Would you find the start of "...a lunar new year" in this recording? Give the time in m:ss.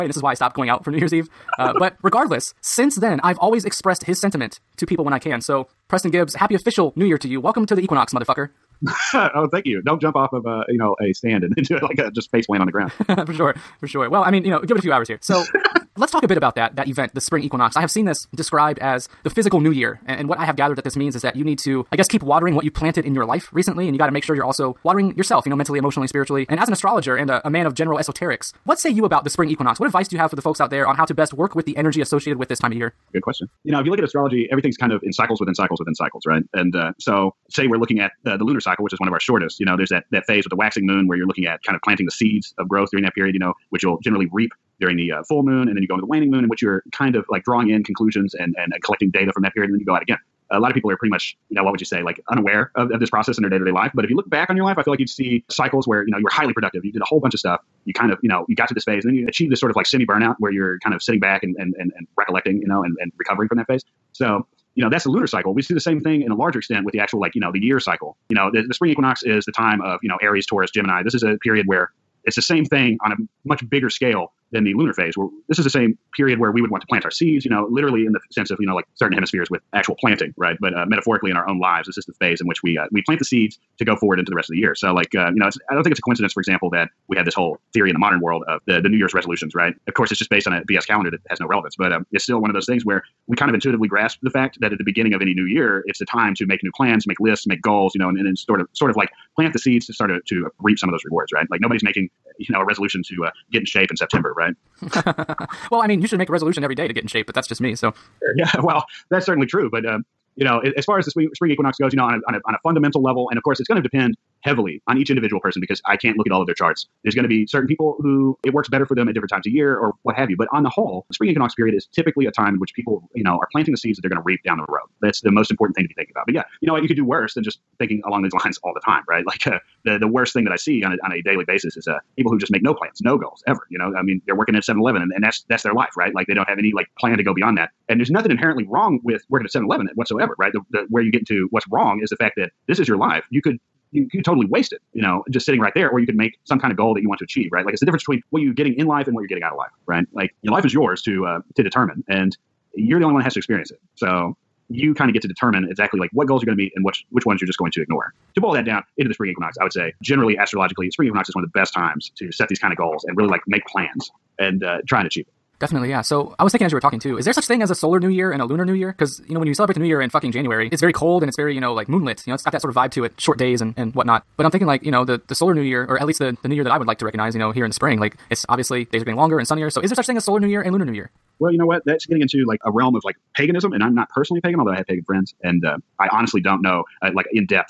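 2:48.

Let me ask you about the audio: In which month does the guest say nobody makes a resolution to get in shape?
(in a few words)
September.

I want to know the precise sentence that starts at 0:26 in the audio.
And as an astrologer and a, a man of general esoterics, what say you about the spring equinox?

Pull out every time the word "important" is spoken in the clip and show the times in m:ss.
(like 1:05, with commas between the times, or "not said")
2:05.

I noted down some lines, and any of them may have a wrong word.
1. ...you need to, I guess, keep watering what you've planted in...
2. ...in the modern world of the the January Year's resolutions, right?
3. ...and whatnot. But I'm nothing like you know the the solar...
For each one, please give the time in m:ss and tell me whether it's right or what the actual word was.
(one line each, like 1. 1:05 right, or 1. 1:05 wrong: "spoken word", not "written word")
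1. 0:21 right
2. 1:27 wrong: "New", not "January"
3. 2:53 wrong: "thinking", not "nothing".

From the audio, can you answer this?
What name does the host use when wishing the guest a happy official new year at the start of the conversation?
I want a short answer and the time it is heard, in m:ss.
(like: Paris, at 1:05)
Preston Gibbs, at 0:05.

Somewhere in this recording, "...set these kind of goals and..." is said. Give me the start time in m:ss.
2:42.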